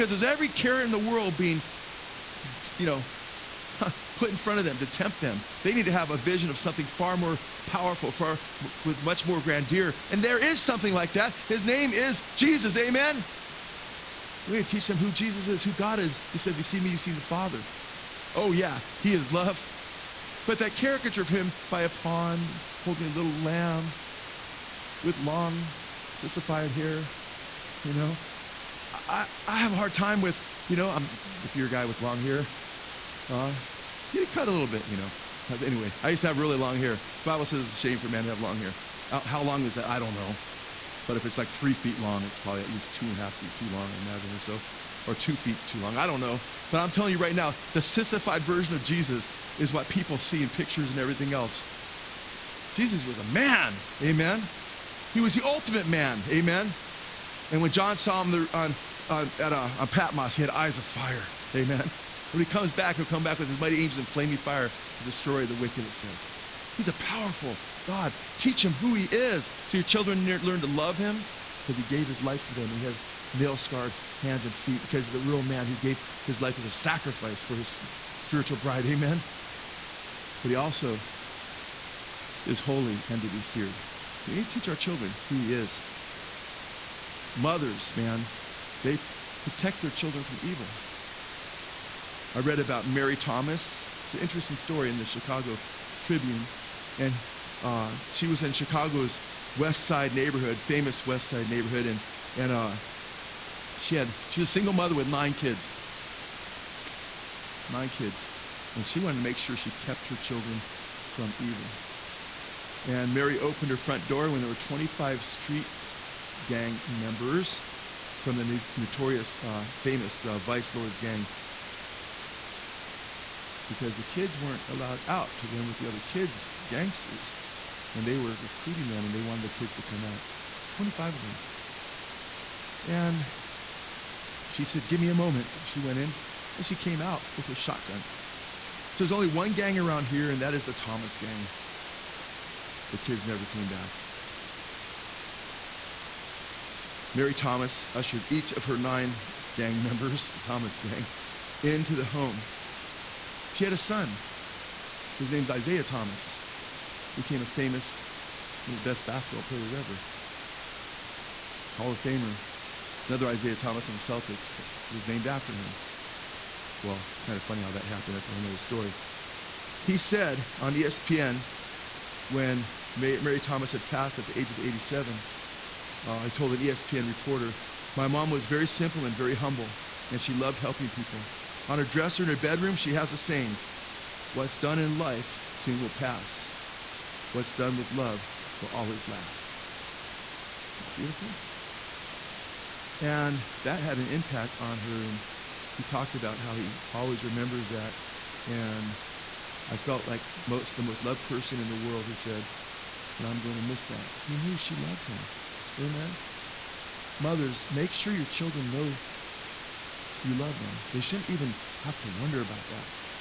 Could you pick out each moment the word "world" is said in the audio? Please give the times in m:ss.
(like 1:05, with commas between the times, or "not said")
0:00, 3:21.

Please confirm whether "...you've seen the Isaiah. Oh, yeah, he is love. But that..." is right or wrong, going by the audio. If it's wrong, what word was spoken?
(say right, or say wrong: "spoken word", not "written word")
wrong: "Father", not "Isaiah".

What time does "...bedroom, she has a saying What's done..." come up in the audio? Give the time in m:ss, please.
3:02.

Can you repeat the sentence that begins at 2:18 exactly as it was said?
So there's only one gang around here, and that is the Thomas gang.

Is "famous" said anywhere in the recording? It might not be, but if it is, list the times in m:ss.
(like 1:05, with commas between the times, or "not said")
1:40, 1:59, 2:37.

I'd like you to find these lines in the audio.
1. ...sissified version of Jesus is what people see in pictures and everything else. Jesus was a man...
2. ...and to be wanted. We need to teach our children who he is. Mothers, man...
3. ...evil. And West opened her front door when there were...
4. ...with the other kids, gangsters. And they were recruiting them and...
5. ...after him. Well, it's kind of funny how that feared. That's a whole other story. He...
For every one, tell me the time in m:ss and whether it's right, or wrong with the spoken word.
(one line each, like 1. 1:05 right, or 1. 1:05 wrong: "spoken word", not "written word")
1. 0:47 right
2. 1:23 wrong: "feared", not "wanted"
3. 1:51 wrong: "Mary", not "West"
4. 2:05 right
5. 2:45 wrong: "happened", not "feared".